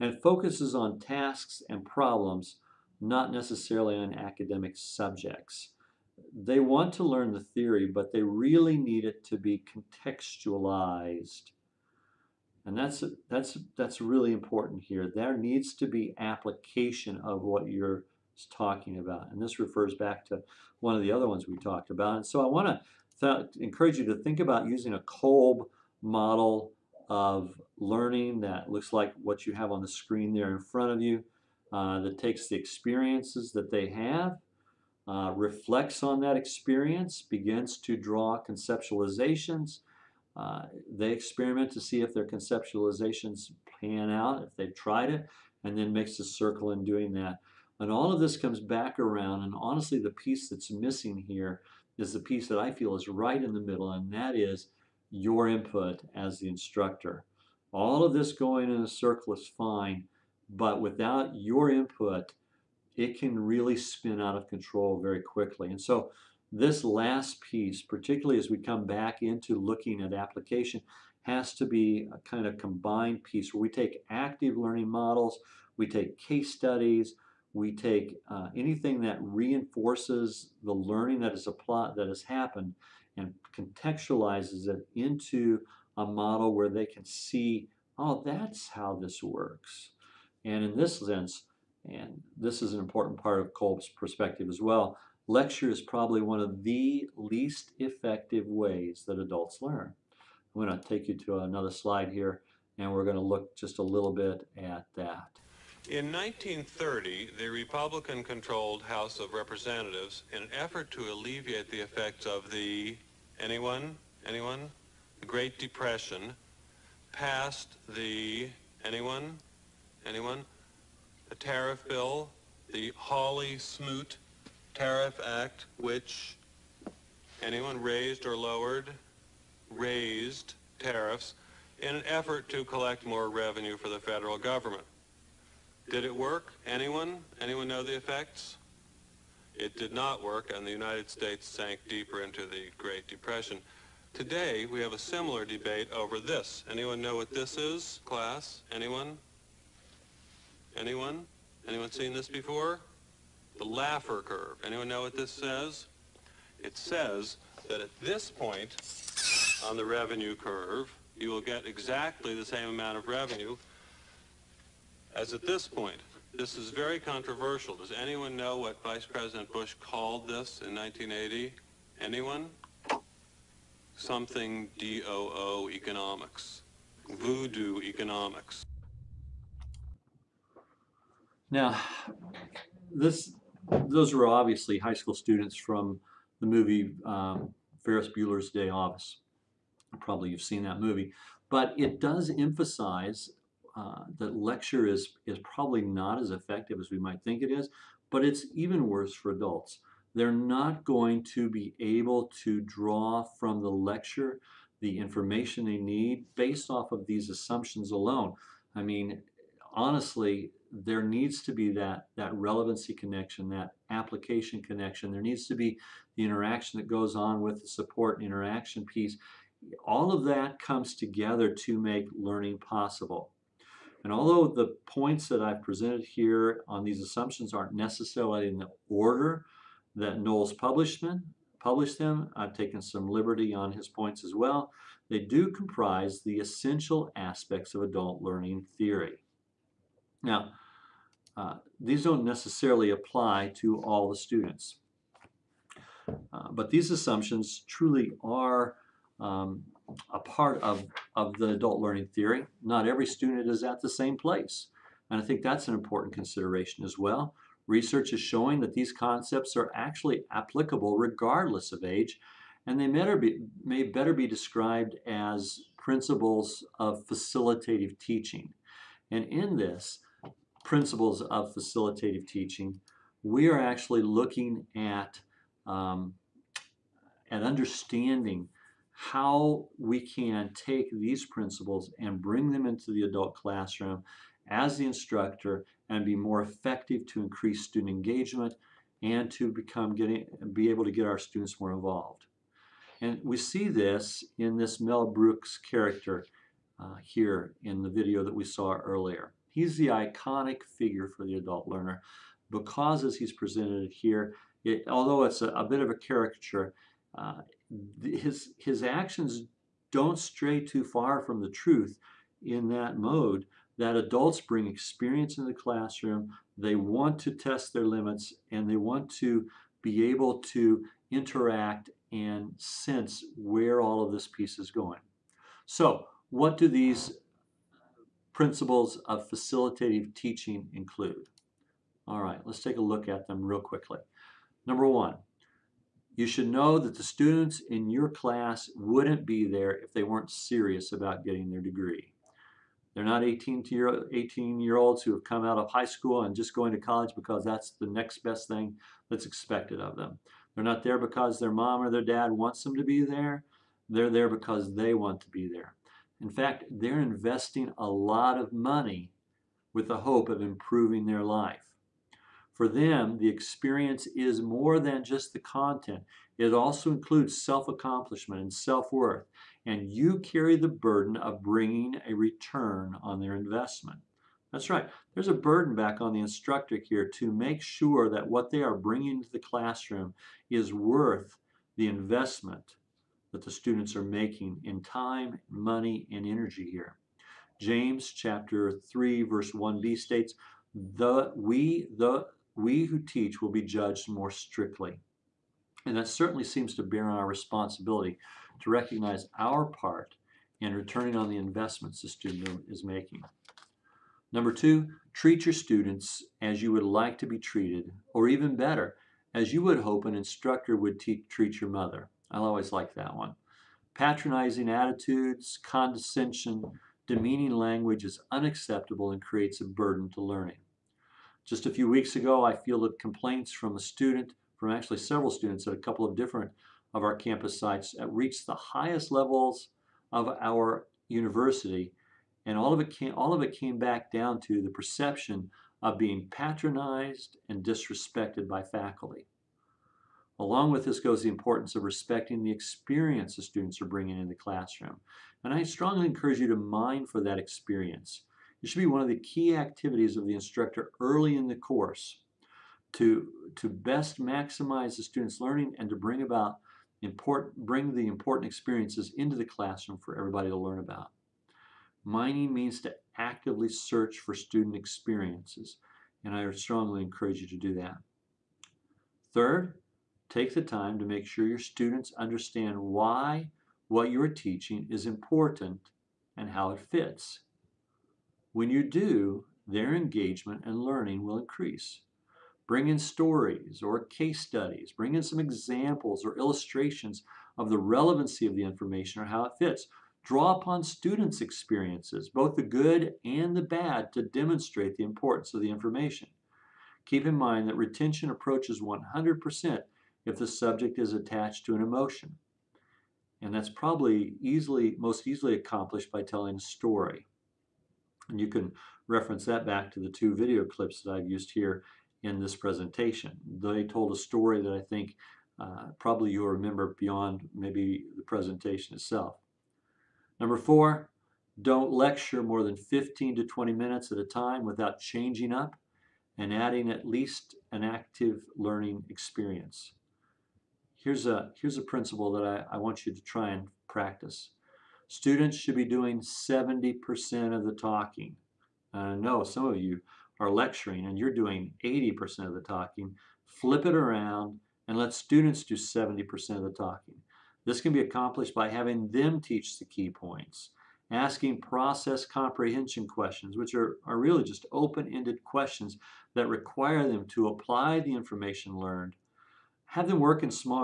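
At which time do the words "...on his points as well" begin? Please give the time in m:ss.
3:53.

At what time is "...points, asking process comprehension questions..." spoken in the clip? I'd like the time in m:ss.
9:10.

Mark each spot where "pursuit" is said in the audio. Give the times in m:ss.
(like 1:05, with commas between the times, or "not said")
not said.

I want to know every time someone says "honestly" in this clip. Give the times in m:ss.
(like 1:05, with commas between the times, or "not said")
0:49, 3:29.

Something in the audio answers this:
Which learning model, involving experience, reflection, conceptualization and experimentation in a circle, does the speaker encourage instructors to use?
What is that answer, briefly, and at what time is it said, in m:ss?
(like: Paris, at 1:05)
Kolb model, at 0:25.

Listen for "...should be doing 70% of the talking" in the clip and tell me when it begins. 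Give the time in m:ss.
8:55.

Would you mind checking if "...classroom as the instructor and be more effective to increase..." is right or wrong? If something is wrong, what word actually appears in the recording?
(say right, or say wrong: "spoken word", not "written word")
right.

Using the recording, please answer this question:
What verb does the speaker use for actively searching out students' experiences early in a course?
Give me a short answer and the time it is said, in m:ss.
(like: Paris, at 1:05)
Mining, at 7:42.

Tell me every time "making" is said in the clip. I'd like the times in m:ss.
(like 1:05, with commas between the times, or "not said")
6:24, 6:42.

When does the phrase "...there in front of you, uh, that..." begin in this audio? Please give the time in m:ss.
0:30.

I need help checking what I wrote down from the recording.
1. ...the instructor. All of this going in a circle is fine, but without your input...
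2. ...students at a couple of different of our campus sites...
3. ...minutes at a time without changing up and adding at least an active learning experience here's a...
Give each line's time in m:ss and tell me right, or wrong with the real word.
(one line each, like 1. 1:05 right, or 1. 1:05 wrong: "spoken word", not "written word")
1. 0:56 right
2. 7:05 right
3. 8:43 right.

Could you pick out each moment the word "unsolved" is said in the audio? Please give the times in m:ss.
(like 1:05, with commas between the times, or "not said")
not said.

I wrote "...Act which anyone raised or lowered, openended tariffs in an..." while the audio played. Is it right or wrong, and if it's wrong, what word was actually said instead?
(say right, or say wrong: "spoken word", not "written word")
wrong: "raised", not "openended".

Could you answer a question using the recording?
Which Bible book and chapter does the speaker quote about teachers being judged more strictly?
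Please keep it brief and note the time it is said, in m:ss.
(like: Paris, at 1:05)
James chapter 3, at 6:27.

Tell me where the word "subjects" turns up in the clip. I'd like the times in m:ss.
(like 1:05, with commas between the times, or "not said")
0:04, 8:20.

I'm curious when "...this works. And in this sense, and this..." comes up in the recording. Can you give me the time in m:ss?
1:29.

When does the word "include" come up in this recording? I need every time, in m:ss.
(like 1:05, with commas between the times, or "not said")
5:30, 6:06.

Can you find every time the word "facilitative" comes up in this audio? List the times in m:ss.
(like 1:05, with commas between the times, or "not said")
4:27, 4:31, 5:29.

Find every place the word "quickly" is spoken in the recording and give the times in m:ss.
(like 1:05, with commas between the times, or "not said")
1:05, 5:33.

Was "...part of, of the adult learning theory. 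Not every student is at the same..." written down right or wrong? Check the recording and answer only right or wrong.
right.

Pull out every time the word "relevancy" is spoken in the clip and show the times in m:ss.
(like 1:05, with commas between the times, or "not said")
3:32, 8:07.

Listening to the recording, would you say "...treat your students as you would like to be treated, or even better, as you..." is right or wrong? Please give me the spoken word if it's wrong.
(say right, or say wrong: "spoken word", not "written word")
right.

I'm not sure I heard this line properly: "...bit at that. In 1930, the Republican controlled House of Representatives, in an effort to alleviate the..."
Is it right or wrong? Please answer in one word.
right.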